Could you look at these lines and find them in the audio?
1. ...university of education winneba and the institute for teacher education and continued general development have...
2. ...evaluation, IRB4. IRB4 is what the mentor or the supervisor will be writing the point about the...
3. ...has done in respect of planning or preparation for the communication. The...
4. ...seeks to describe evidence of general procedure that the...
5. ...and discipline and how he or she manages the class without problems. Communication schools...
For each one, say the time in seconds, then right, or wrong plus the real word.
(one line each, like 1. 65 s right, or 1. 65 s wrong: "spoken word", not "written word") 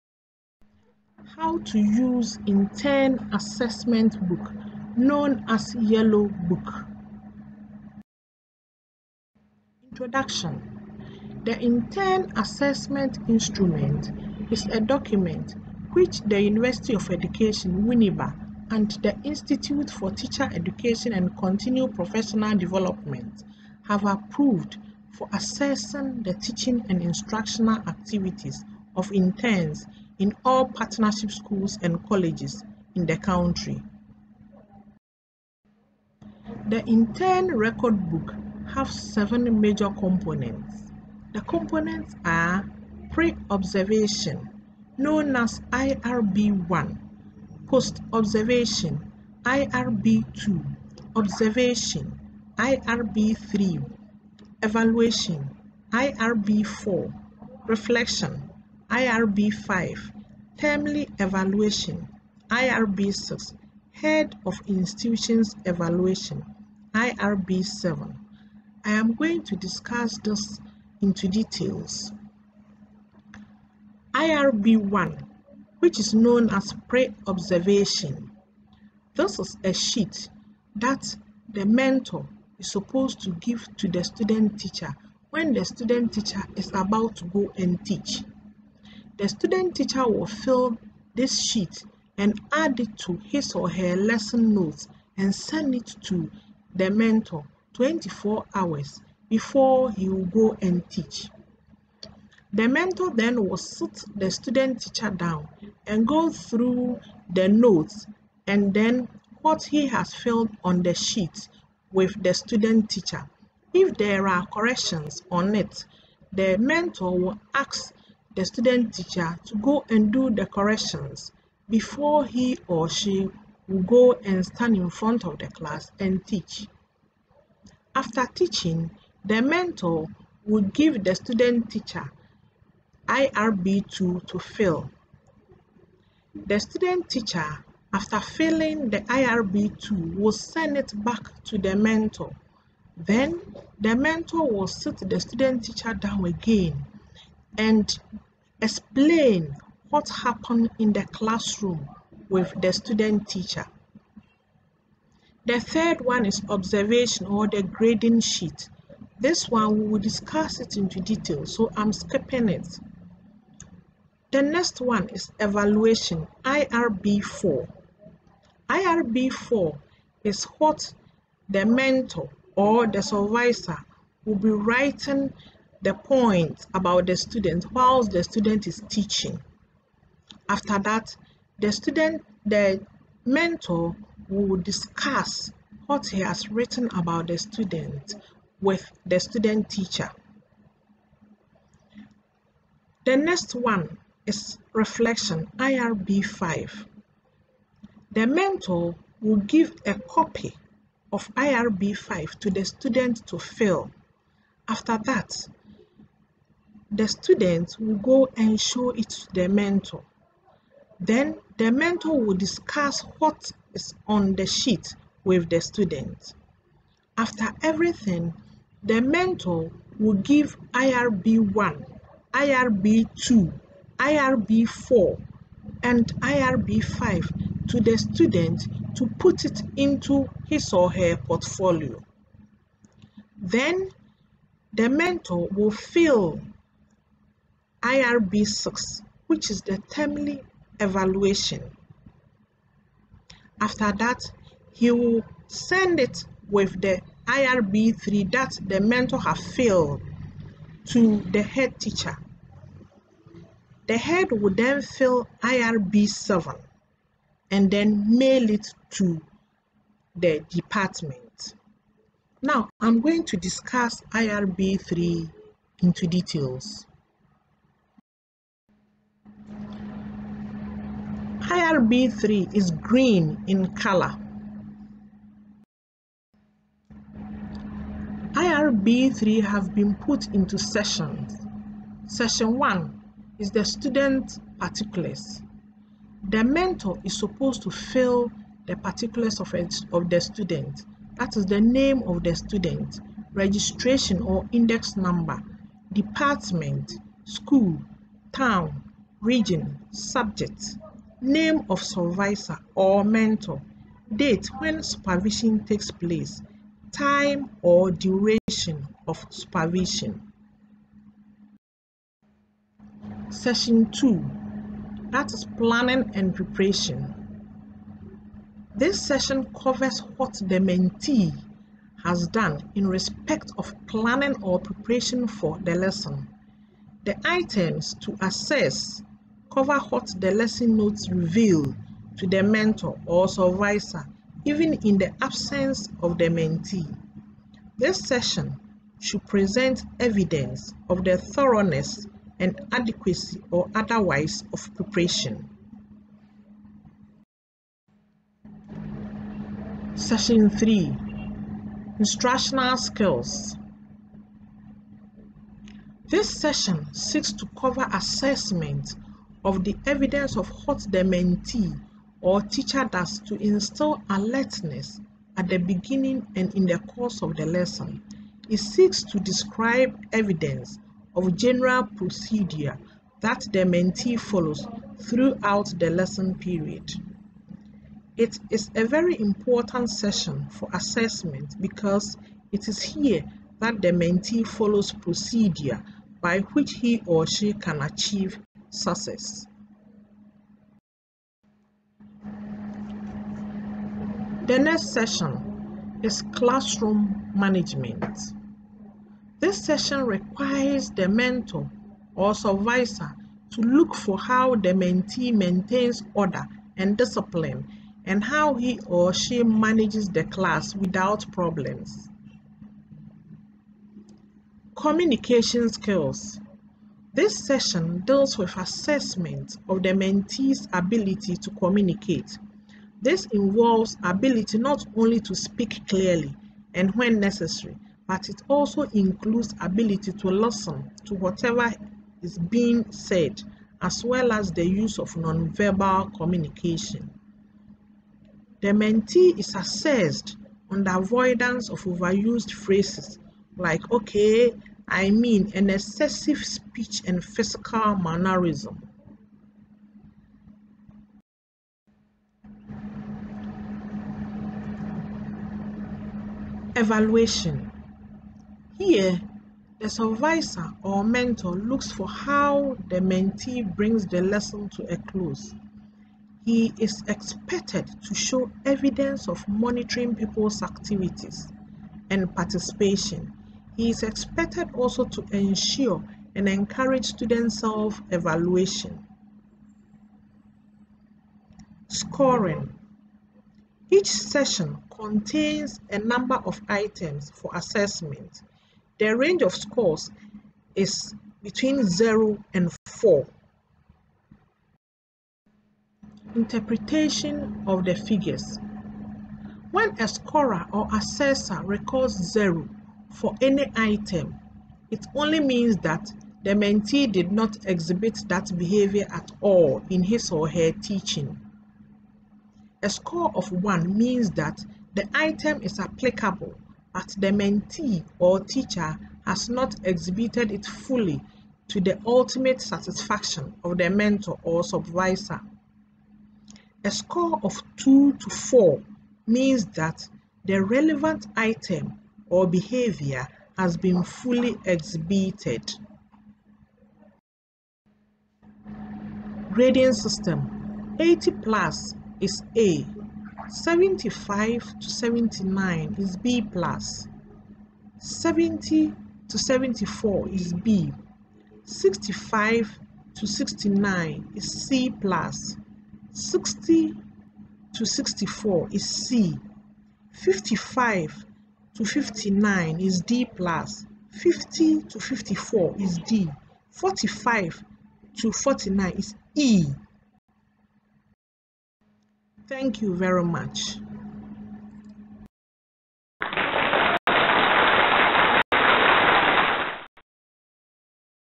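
1. 16 s wrong: "professional", not "general"
2. 165 s right
3. 322 s wrong: "lesson", not "communication"
4. 368 s right
5. 406 s wrong: "skills", not "schools".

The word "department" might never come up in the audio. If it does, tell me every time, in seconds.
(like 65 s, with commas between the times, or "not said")
260 s, 295 s.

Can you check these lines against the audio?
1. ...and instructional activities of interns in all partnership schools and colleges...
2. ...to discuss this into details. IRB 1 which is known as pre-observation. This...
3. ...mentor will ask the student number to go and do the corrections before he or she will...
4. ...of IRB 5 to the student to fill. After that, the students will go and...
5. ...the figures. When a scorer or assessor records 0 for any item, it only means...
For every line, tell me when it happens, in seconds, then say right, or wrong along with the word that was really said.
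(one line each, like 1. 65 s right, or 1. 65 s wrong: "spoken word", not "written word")
1. 26 s right
2. 69 s right
3. 116 s wrong: "teacher", not "number"
4. 201 s right
5. 497 s right.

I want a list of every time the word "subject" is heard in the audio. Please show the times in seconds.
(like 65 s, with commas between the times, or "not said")
299 s.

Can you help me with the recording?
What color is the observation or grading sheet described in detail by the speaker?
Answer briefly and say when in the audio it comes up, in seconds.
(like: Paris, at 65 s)
Green, at 272 s.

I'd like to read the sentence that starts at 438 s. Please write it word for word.
The mentee is assessed on the avoidance of overused phrases like okay, I mean, and excessive speech and physical mannerism.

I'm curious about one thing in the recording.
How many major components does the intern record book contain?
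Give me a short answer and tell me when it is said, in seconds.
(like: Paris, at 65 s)
7, at 38 s.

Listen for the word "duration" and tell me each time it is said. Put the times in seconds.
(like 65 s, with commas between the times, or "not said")
307 s.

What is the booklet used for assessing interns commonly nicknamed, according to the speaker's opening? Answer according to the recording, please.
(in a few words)
Yellow book.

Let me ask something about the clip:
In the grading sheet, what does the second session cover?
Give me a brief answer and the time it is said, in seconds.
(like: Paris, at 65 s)
Planning and preparation, at 315 s.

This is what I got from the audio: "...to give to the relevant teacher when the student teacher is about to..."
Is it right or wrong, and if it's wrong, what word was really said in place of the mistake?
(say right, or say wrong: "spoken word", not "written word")
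wrong: "student", not "relevant".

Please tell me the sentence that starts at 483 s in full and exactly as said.
Each session contains a number of items for assessment.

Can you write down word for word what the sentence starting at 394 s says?
The next session is classroom management.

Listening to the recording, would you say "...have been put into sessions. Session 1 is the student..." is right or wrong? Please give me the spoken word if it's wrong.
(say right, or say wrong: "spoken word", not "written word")
right.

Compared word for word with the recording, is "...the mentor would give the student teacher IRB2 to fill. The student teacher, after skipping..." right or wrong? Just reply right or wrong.
wrong.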